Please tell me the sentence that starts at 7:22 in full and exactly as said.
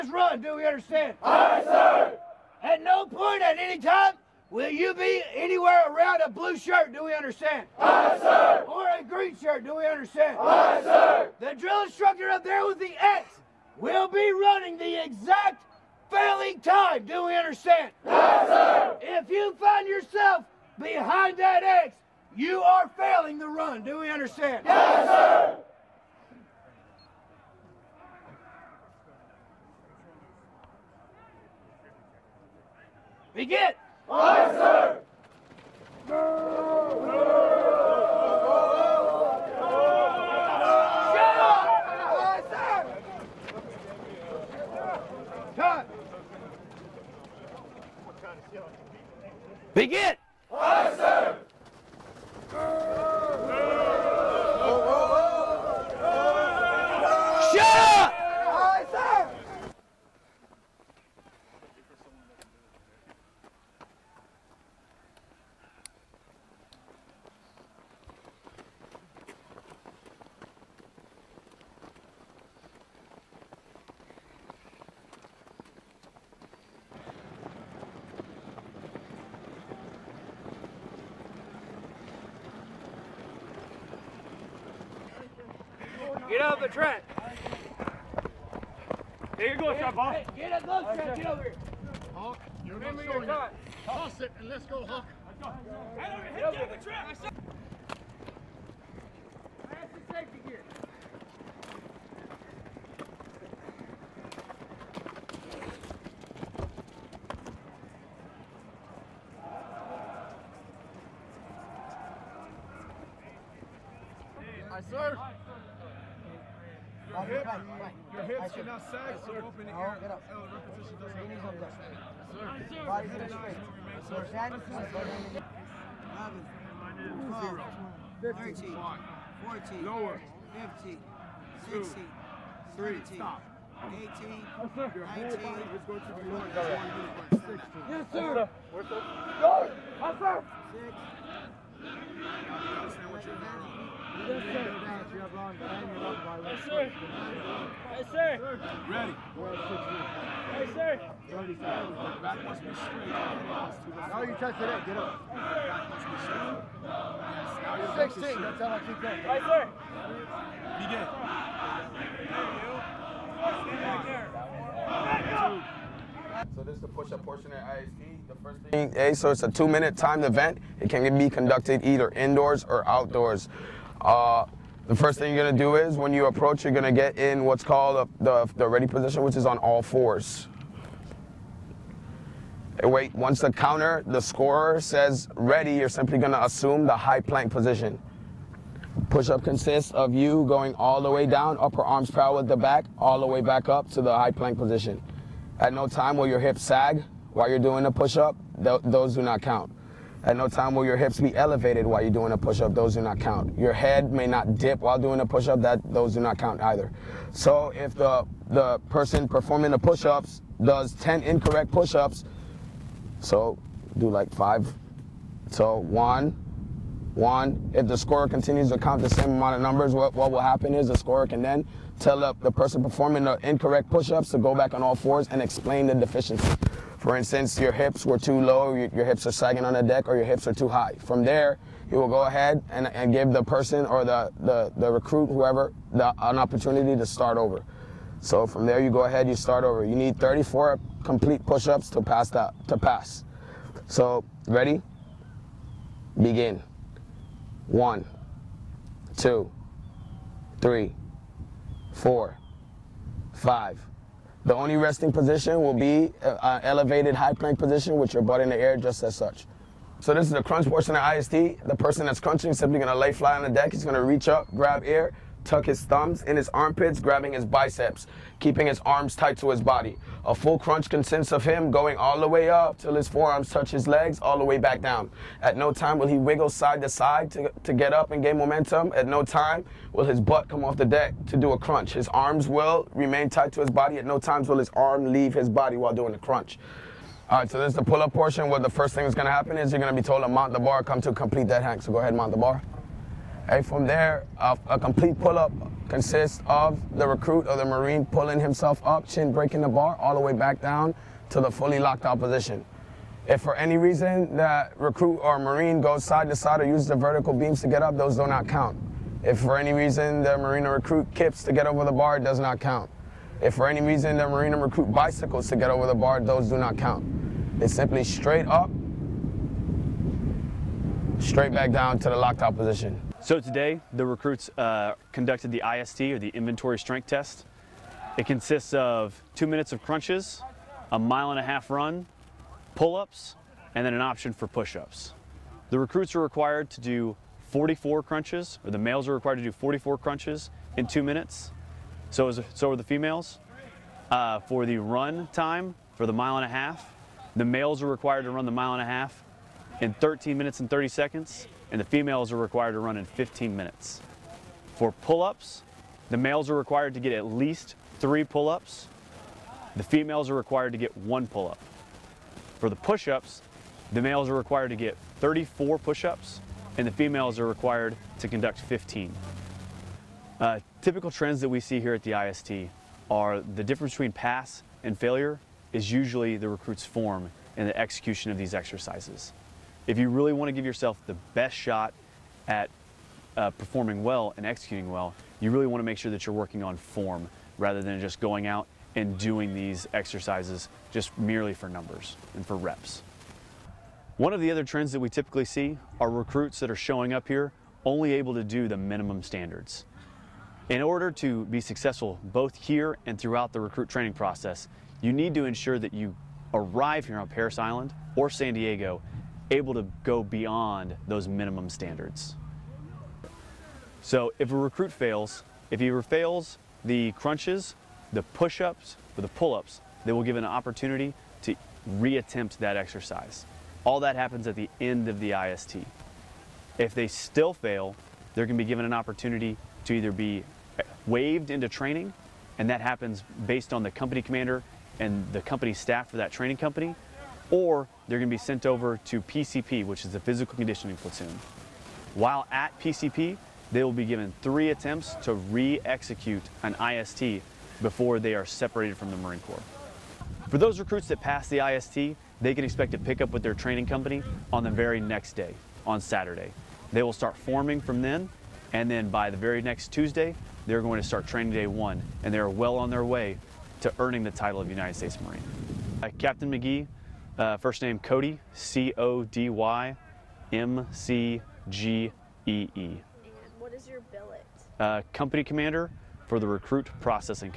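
While at PCP, they will be given three attempts to re-execute an IST before they are separated from the Marine Corps.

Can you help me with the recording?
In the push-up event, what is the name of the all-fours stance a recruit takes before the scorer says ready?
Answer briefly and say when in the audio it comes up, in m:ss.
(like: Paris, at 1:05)
ready position, at 2:58.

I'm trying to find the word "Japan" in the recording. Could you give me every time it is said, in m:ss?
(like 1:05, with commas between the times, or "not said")
not said.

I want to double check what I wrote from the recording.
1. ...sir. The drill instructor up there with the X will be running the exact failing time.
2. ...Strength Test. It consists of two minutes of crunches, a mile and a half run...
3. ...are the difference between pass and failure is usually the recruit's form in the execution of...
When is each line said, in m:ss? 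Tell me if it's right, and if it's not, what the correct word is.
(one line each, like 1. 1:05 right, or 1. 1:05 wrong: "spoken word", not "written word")
1. 0:10 right
2. 5:26 right
3. 6:13 right.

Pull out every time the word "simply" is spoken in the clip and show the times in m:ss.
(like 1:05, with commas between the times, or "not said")
3:05, 4:22, 5:17.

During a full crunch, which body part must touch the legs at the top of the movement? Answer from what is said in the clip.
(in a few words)
forearms.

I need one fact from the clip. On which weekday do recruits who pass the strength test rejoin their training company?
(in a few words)
Saturday.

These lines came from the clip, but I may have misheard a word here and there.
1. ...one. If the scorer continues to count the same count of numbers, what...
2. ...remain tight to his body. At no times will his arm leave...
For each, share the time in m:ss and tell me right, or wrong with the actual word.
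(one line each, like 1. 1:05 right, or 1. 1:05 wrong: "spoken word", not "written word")
1. 3:37 wrong: "amount", not "count"
2. 4:42 right.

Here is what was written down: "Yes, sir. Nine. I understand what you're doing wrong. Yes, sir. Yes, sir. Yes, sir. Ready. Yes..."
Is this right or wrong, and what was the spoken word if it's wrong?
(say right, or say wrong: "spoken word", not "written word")
wrong: "Six", not "Nine".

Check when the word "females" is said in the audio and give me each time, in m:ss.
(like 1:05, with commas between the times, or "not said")
5:42, 5:51, 5:59, 6:06.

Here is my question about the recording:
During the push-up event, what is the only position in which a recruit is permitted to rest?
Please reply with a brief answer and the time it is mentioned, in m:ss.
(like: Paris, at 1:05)
elevated high plank position, at 4:16.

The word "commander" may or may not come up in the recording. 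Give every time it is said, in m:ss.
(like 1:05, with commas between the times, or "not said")
7:14, 7:55.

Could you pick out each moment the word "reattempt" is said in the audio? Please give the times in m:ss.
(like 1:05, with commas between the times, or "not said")
7:01.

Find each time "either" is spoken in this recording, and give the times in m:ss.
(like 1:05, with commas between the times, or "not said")
2:51, 3:26, 7:09.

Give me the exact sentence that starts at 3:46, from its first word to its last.
For instance, your hips were too low, your, hips are sagging on the deck, or your hips are too high.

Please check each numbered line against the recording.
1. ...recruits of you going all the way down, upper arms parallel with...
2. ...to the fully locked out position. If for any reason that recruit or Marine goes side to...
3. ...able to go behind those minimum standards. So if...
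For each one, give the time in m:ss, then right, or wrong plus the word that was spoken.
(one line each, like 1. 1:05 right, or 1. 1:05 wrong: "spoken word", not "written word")
1. 3:09 wrong: "consists", not "recruits"
2. 5:01 right
3. 6:49 wrong: "beyond", not "behind".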